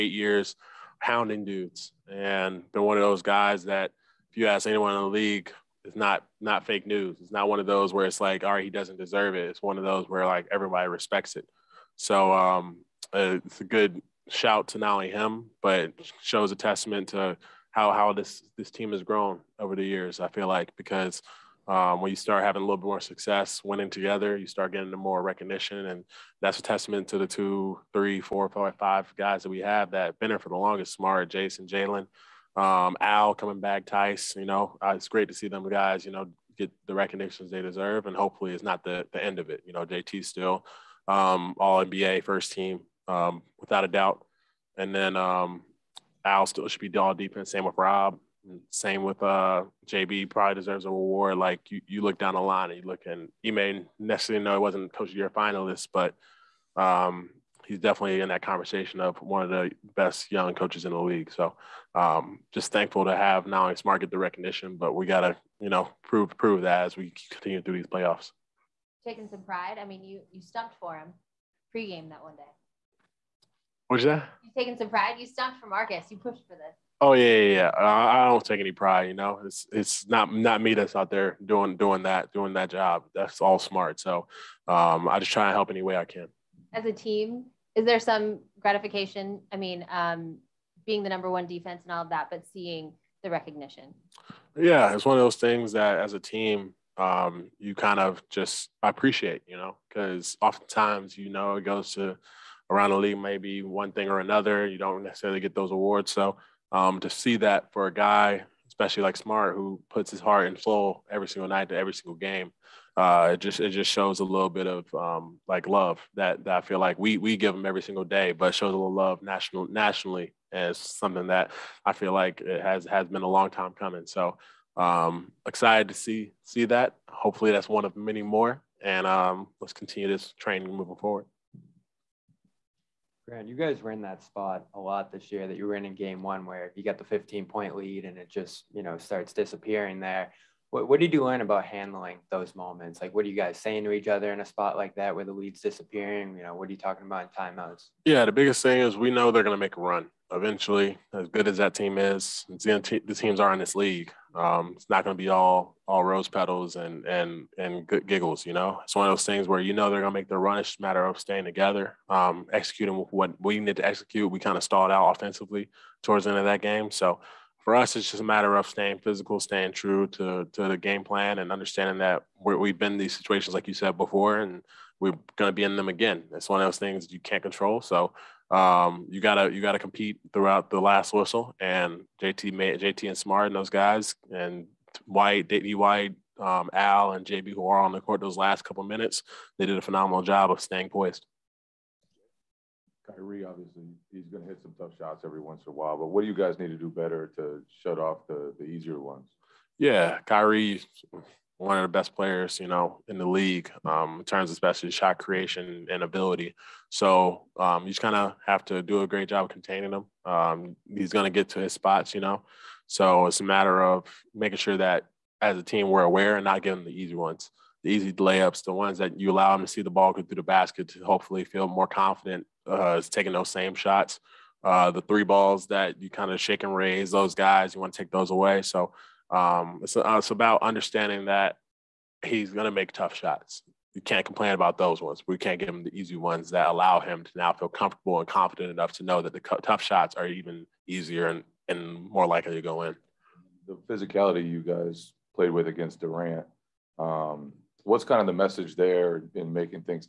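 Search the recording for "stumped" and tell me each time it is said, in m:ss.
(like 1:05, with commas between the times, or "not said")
1:10, 1:15.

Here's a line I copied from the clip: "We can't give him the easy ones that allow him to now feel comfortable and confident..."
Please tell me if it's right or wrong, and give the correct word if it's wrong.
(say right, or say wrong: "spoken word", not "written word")
right.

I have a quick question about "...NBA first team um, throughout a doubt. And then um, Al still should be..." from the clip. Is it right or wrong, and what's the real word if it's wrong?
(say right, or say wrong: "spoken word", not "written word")
wrong: "without", not "throughout".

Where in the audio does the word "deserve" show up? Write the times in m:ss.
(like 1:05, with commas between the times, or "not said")
0:08, 0:37, 0:50.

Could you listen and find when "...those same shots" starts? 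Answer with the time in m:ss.
3:43.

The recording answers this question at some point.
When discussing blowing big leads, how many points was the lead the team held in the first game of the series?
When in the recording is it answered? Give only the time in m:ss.
2:17.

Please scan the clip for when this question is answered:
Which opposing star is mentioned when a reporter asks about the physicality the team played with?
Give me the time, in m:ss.
4:05.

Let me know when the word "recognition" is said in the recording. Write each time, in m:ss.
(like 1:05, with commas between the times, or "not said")
0:25, 0:36, 1:04, 1:33.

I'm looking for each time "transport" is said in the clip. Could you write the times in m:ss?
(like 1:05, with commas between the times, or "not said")
not said.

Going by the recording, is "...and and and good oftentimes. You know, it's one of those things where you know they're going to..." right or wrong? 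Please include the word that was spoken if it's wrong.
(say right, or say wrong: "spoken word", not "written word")
wrong: "giggles", not "oftentimes".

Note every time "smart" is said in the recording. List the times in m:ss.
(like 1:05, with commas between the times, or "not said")
0:30, 1:03, 1:23, 1:49, 3:03.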